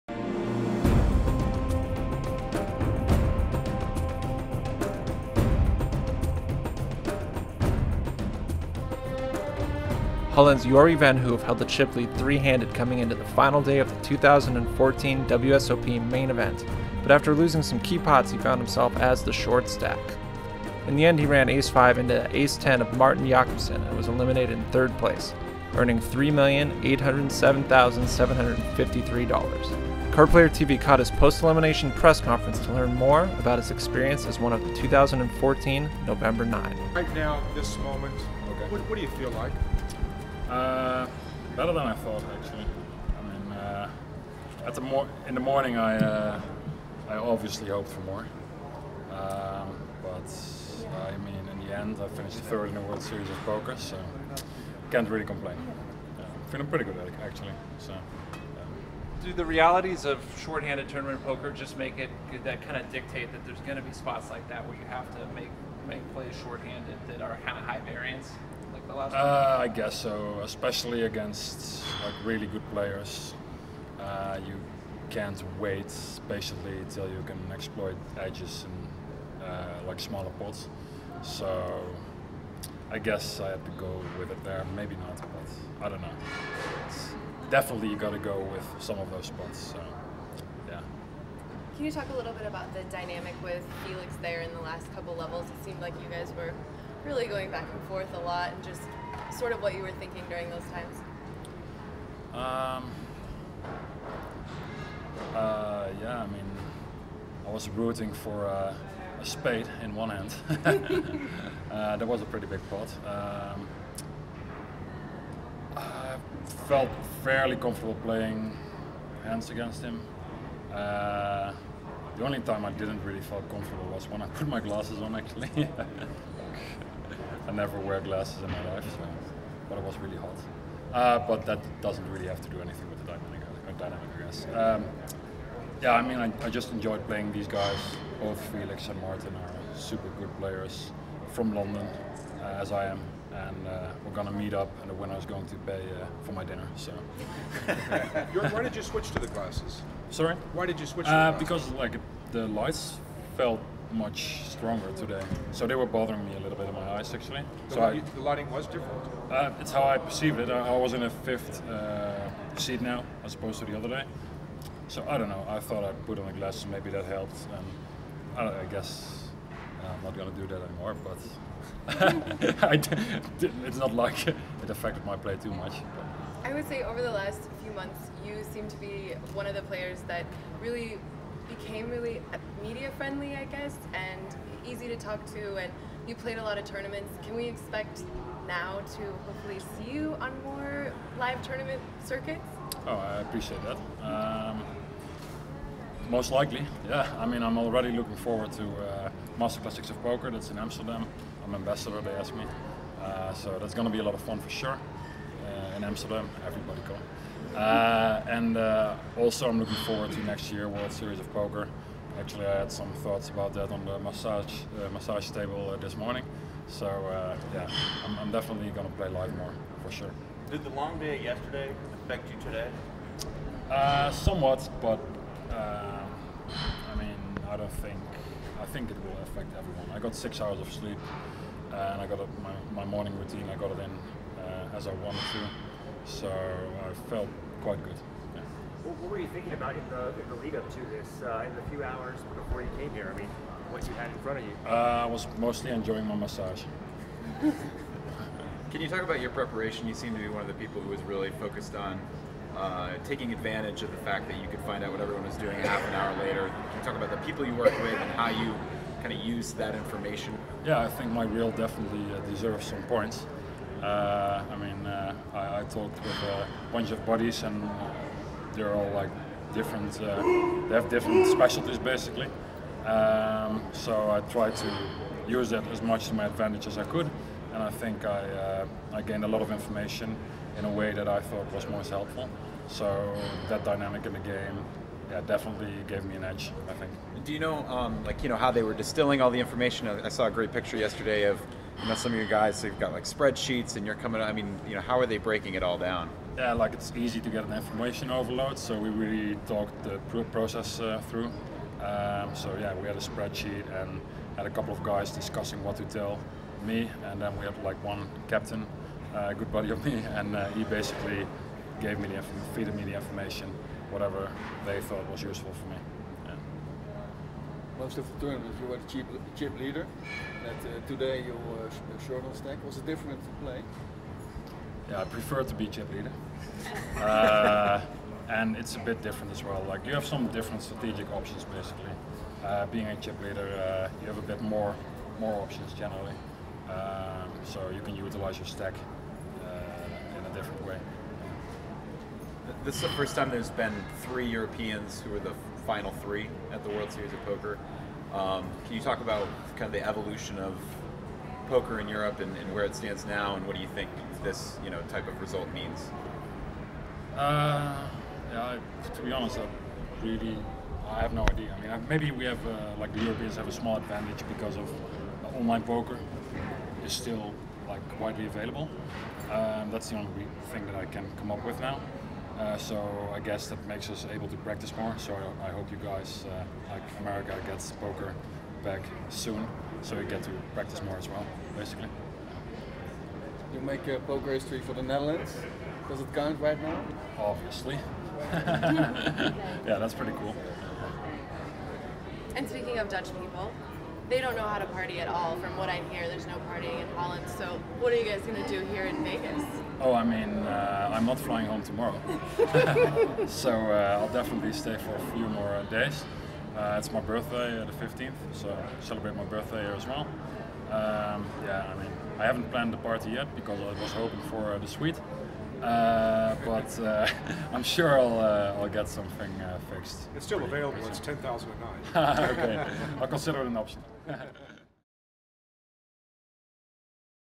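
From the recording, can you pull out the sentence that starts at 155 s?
So they were bothering me a little bit in my eyes actually.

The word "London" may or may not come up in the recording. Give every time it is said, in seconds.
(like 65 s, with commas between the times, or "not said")
141 s.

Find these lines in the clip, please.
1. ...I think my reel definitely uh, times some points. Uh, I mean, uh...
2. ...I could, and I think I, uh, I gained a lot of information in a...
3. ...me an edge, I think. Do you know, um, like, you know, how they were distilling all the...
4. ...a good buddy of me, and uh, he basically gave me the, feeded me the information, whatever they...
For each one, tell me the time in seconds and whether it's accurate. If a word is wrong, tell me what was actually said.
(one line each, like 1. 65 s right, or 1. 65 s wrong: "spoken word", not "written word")
1. 260 s wrong: "deserves", not "times"
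2. 276 s right
3. 286 s right
4. 309 s right.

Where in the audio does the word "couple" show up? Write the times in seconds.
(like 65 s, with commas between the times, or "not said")
94 s, 304 s.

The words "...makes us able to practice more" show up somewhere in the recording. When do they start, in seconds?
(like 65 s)
373 s.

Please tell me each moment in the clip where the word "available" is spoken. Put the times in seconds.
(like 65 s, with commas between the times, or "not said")
368 s, 420 s.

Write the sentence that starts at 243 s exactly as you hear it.
I mean, what you had in front of you?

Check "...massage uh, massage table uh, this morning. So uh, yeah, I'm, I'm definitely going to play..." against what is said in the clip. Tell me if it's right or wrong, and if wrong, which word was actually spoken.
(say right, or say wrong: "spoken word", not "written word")
right.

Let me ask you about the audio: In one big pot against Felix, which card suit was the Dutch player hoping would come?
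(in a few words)
spade.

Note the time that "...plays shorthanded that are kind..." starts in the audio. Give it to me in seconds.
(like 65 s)
66 s.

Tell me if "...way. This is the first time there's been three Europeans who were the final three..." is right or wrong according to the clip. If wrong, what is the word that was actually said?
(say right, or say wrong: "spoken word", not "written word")
right.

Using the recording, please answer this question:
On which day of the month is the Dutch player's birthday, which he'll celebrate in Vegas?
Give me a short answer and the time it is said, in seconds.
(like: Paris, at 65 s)
15th, at 407 s.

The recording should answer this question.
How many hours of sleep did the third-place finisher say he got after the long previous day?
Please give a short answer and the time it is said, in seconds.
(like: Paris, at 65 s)
6, at 230 s.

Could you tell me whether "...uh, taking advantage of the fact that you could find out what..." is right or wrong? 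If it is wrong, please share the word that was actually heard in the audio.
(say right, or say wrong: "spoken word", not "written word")
right.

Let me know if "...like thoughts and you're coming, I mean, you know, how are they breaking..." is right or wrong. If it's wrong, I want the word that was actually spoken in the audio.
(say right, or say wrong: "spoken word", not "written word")
wrong: "spreadsheets", not "thoughts".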